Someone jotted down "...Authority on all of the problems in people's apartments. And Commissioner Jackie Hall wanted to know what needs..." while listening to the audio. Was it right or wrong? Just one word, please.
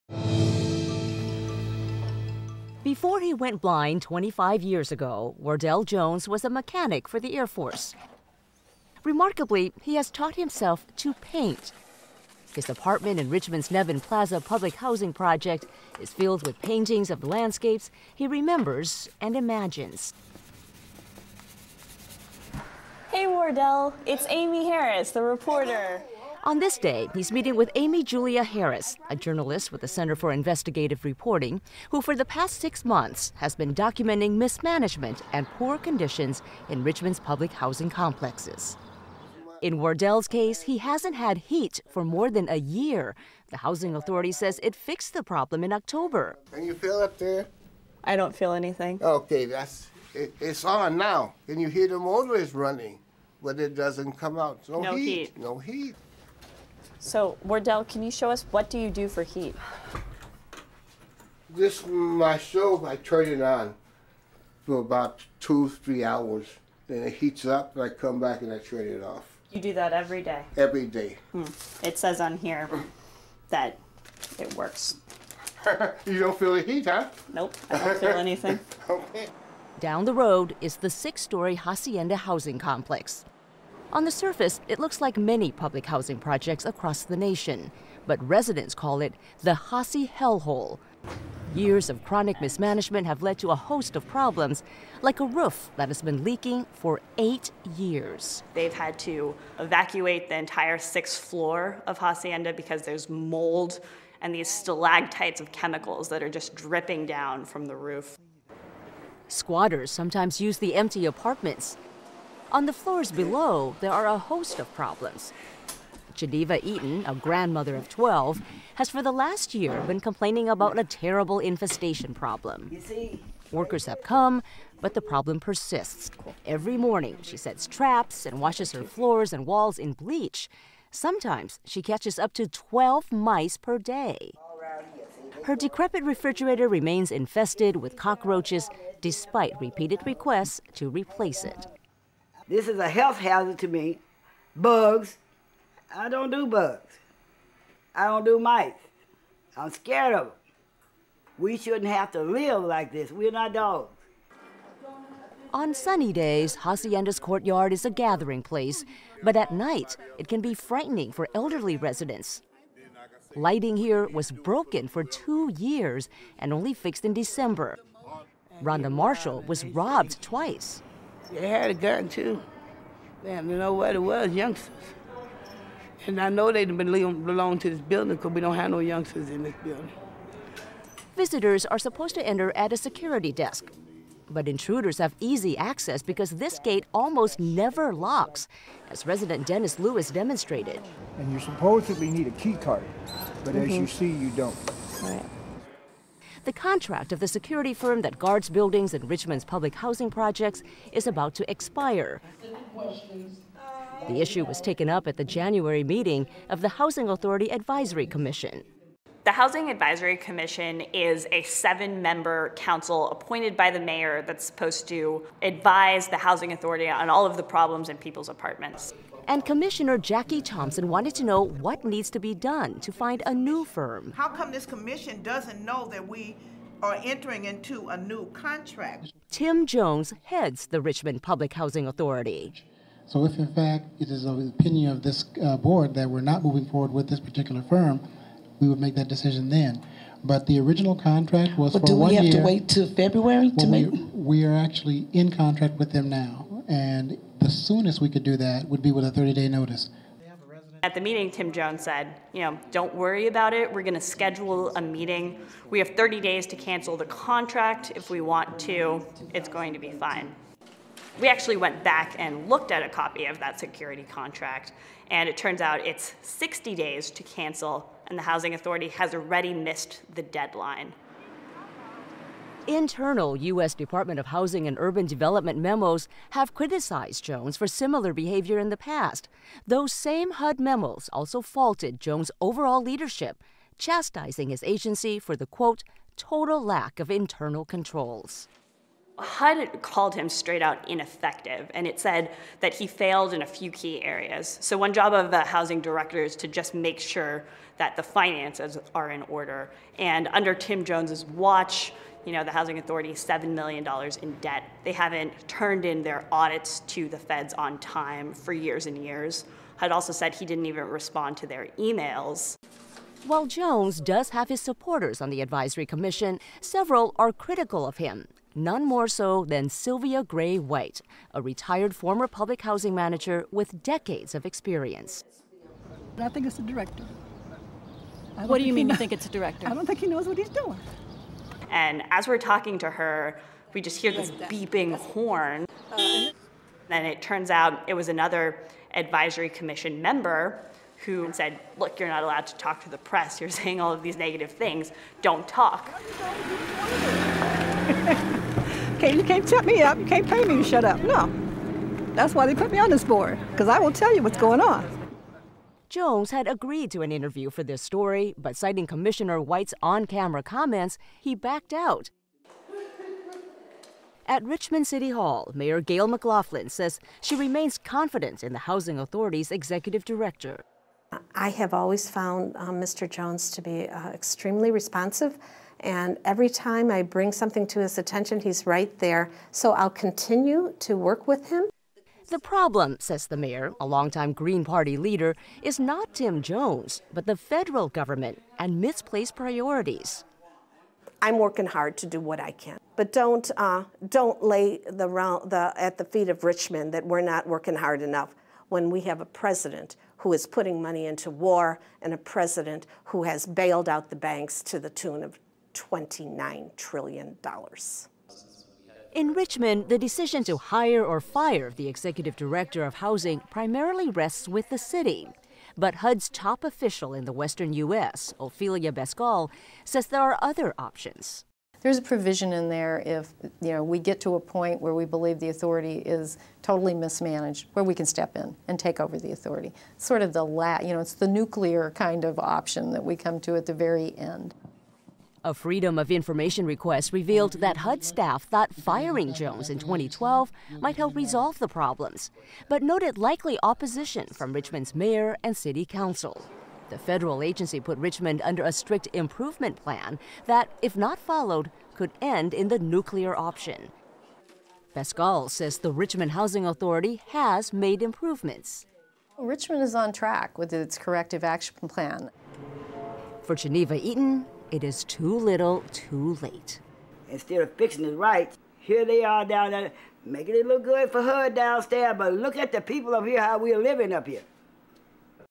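wrong.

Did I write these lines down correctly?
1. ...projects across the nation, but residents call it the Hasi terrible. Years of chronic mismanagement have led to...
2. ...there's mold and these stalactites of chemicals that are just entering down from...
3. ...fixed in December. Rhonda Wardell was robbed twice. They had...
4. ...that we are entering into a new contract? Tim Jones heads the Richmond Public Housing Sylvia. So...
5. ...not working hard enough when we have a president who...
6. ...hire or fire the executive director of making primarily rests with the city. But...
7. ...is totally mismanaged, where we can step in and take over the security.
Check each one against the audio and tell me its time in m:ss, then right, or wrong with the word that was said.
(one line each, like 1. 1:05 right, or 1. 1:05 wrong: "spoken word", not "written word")
1. 1:26 wrong: "hellhole", not "terrible"
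2. 1:42 wrong: "dripping", not "entering"
3. 2:46 wrong: "Marshall", not "Wardell"
4. 3:45 wrong: "Authority", not "Sylvia"
5. 6:37 right
6. 6:50 wrong: "housing", not "making"
7. 7:05 wrong: "authority", not "security".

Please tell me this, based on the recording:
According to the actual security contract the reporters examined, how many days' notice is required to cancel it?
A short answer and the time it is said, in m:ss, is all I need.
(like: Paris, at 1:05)
60, at 4:26.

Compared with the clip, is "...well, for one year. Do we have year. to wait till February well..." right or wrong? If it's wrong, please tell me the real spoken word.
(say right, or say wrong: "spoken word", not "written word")
right.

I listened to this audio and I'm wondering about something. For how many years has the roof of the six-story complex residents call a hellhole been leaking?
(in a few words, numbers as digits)
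8.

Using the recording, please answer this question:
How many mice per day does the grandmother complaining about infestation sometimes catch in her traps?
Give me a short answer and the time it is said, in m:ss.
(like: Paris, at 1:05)
12, at 2:12.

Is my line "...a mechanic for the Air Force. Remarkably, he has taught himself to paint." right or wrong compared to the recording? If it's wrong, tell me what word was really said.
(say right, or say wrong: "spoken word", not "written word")
right.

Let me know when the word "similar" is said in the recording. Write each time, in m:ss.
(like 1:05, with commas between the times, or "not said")
4:37.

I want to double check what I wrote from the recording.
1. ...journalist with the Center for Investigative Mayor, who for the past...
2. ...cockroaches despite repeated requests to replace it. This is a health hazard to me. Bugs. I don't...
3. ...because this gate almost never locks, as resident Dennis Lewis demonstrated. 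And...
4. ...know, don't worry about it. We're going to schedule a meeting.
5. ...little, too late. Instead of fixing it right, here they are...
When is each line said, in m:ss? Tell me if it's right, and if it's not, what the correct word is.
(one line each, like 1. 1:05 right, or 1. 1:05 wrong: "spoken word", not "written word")
1. 0:29 wrong: "Reporting", not "Mayor"
2. 2:17 right
3. 3:06 right
4. 4:12 right
5. 7:45 right.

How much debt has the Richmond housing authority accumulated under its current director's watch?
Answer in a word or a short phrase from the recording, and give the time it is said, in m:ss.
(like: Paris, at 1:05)
$7 million, at 5:03.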